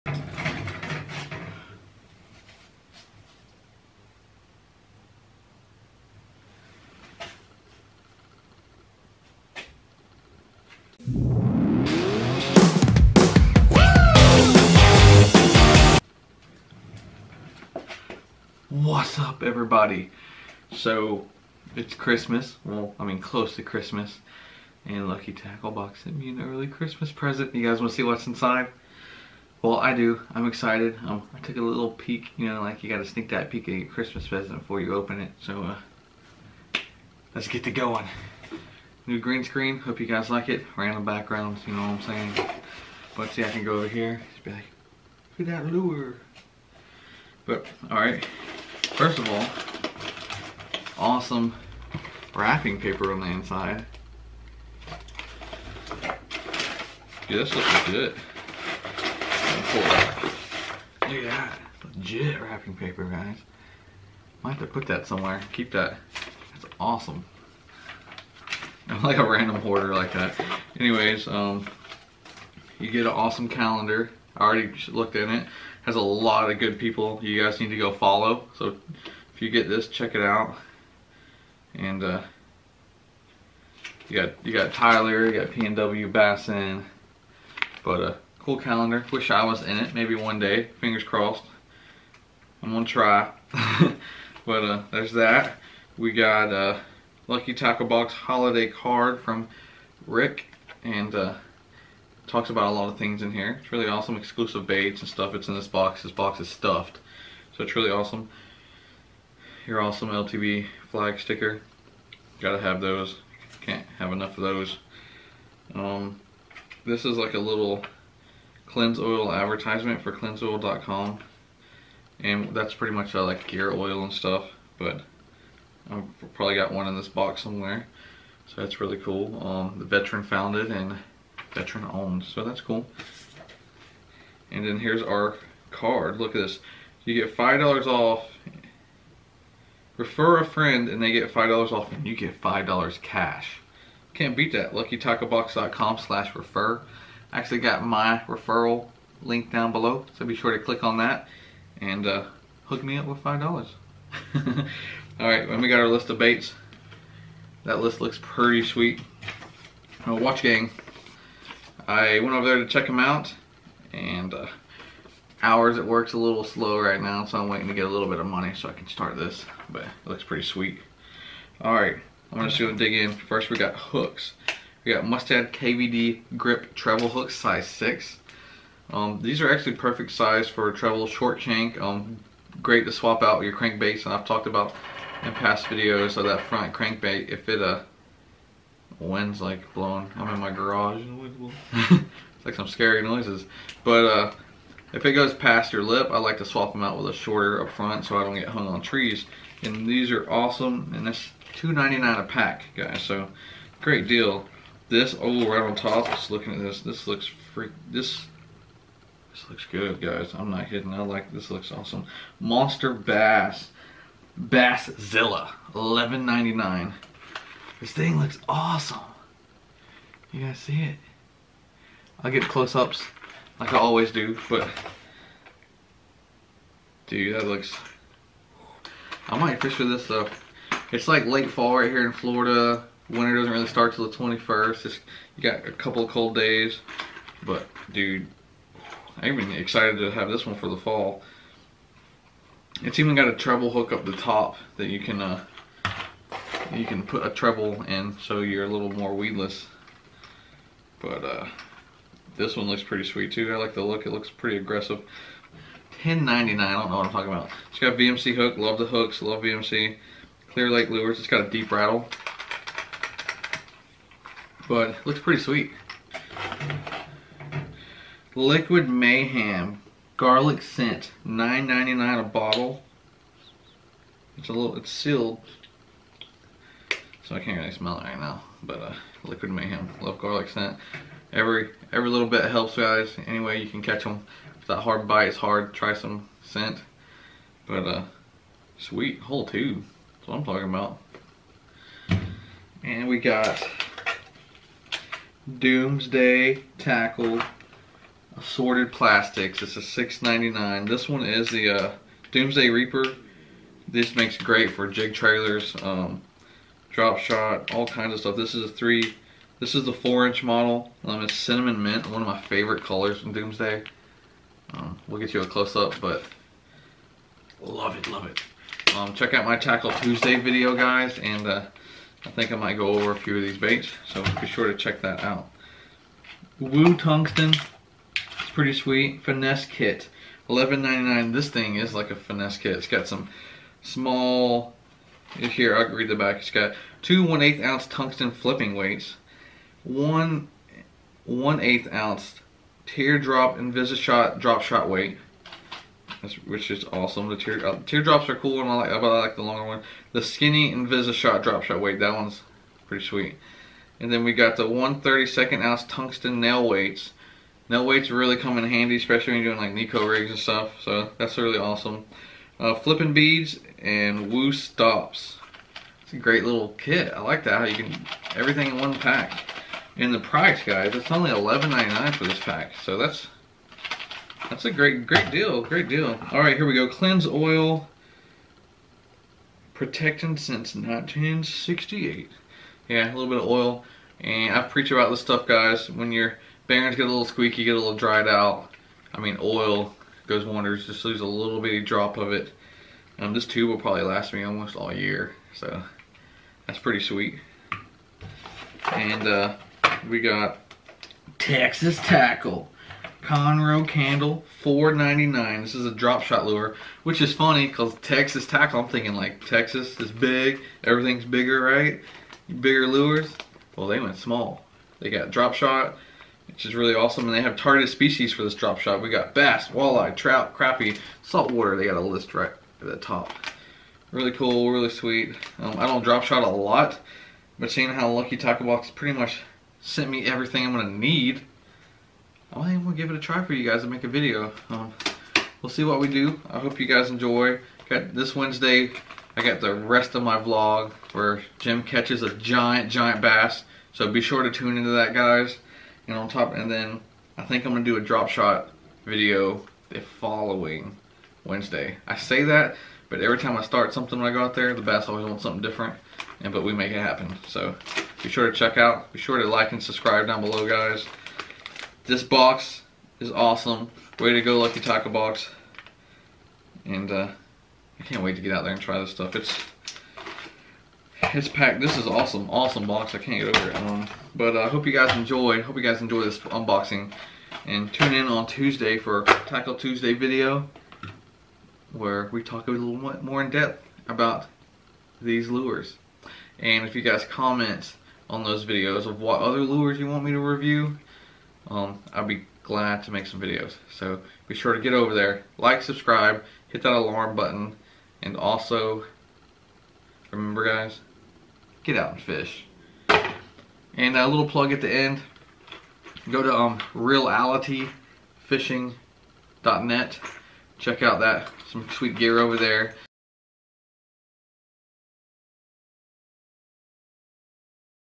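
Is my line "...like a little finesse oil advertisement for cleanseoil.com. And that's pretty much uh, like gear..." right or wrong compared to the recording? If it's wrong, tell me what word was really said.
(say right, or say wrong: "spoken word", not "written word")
wrong: "cleanse", not "finesse".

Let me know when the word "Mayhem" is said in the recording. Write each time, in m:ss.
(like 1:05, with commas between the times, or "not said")
4:28, 4:39.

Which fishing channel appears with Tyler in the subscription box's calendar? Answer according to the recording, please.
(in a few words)
PNW Bassin.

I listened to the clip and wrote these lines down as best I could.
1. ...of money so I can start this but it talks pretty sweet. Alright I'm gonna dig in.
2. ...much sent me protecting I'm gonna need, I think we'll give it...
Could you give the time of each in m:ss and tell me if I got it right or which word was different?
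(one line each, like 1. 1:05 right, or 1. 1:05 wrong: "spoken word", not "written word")
1. 2:48 wrong: "looks", not "talks"
2. 7:09 wrong: "everything", not "protecting".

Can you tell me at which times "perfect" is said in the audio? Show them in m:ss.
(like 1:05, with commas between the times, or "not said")
2:59.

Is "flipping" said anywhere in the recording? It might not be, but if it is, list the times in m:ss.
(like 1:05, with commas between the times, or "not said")
5:38, 6:02.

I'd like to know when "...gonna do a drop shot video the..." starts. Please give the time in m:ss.
7:27.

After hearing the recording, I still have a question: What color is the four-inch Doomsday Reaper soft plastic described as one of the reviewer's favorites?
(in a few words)
Cinnamon mint.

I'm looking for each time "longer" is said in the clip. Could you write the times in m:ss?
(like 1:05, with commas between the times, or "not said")
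5:49.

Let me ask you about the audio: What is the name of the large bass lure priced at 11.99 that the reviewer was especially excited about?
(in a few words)
Basszilla.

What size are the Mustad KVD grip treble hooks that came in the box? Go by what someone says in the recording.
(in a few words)
6.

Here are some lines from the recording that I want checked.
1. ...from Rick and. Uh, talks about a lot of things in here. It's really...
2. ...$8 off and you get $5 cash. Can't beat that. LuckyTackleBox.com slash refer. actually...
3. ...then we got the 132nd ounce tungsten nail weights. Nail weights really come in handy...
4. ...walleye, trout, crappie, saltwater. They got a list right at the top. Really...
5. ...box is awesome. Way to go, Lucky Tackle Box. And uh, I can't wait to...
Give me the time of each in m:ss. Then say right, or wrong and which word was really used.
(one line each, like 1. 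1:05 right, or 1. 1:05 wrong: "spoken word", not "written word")
1. 1:39 right
2. 2:21 wrong: "5", not "8"
3. 5:54 right
4. 6:59 right
5. 7:42 right.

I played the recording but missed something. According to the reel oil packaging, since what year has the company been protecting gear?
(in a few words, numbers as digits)
1968.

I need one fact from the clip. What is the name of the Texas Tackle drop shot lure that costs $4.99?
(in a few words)
Conroe Candle.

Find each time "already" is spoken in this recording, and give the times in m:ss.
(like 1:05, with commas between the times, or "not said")
1:14.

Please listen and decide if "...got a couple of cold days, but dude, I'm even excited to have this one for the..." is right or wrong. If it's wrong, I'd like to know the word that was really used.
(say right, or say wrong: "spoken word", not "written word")
right.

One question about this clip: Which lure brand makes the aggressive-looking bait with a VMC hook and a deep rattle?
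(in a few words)
Clear Lake lures.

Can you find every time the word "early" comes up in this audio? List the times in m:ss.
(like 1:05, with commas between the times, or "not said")
0:26.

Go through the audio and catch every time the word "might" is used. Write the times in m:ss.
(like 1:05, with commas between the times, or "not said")
1:04, 3:49, 5:22.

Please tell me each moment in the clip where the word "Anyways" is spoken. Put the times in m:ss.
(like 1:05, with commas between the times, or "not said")
1:10, 4:43.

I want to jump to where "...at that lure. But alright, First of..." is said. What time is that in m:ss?
0:45.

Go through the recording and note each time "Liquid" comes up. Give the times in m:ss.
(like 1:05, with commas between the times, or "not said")
4:28, 4:39.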